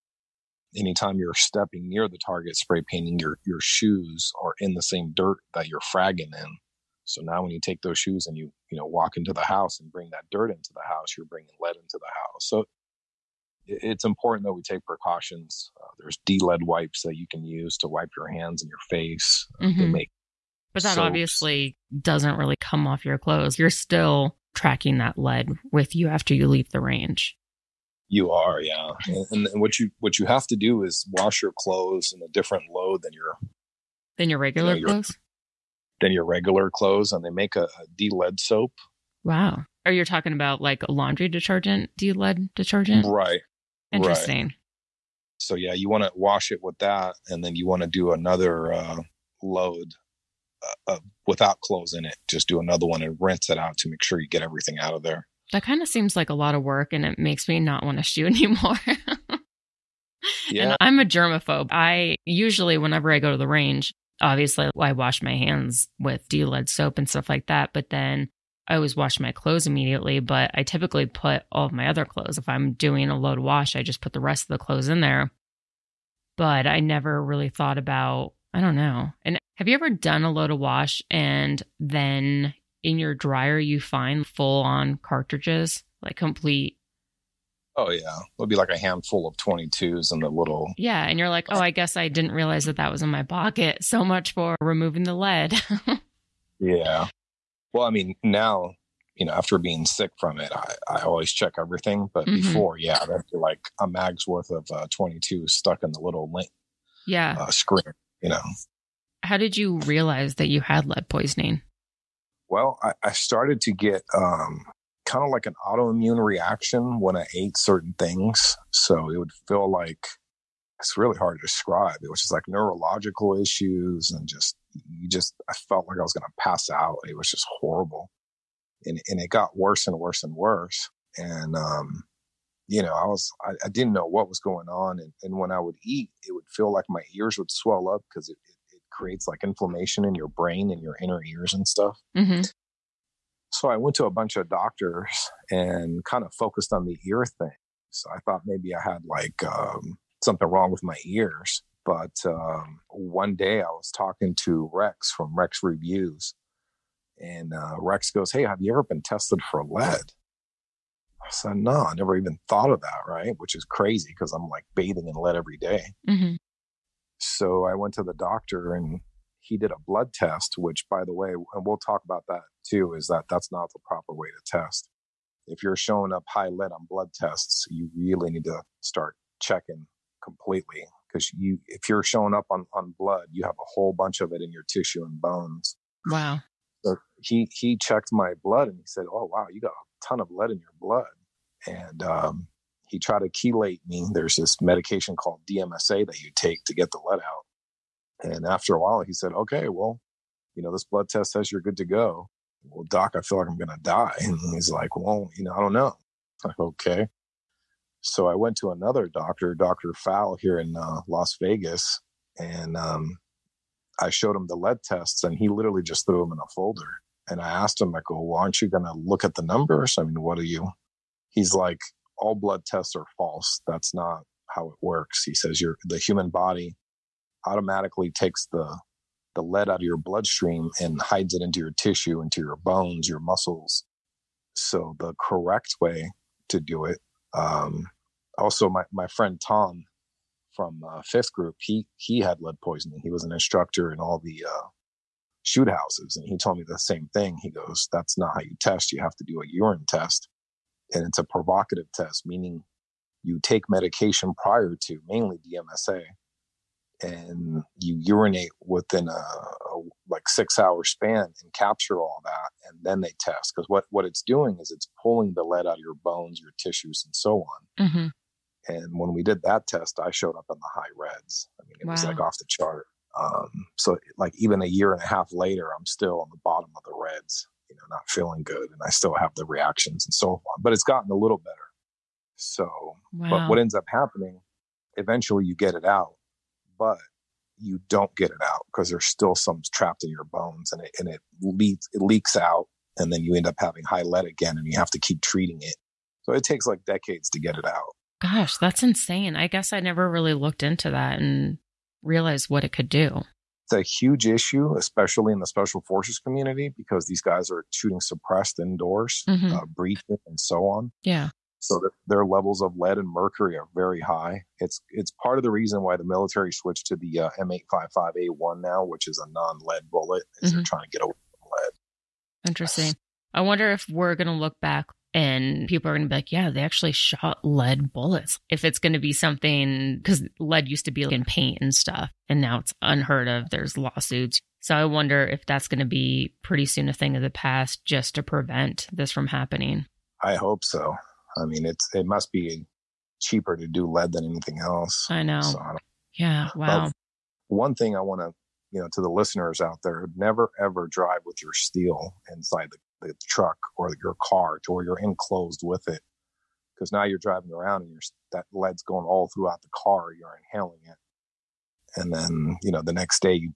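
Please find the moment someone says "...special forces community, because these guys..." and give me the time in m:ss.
5:05.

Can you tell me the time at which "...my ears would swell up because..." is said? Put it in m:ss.
2:16.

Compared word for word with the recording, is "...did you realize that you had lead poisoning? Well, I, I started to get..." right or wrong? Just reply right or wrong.
right.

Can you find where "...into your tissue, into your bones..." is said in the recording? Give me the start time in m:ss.
3:51.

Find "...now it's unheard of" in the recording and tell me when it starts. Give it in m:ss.
5:32.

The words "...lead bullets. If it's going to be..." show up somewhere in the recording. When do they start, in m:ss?
5:27.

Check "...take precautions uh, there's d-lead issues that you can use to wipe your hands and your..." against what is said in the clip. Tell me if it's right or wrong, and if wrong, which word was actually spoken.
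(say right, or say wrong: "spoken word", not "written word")
wrong: "wipes", not "issues".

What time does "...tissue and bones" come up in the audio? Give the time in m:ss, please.
3:04.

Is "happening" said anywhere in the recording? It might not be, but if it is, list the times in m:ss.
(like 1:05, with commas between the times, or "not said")
4:43, 5:39.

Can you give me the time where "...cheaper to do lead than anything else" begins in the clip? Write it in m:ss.
5:43.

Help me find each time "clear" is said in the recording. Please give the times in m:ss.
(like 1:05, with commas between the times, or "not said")
not said.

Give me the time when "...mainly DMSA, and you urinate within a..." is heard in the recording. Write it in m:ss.
4:15.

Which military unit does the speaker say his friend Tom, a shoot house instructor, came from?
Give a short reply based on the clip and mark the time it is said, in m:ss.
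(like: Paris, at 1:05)
Fifth Group, at 4:01.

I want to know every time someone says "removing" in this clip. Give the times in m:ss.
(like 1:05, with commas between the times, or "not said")
1:34.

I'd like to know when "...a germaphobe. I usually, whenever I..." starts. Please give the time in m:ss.
1:00.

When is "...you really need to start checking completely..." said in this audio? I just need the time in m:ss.
2:57.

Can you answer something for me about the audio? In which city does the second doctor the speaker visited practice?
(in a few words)
Las Vegas.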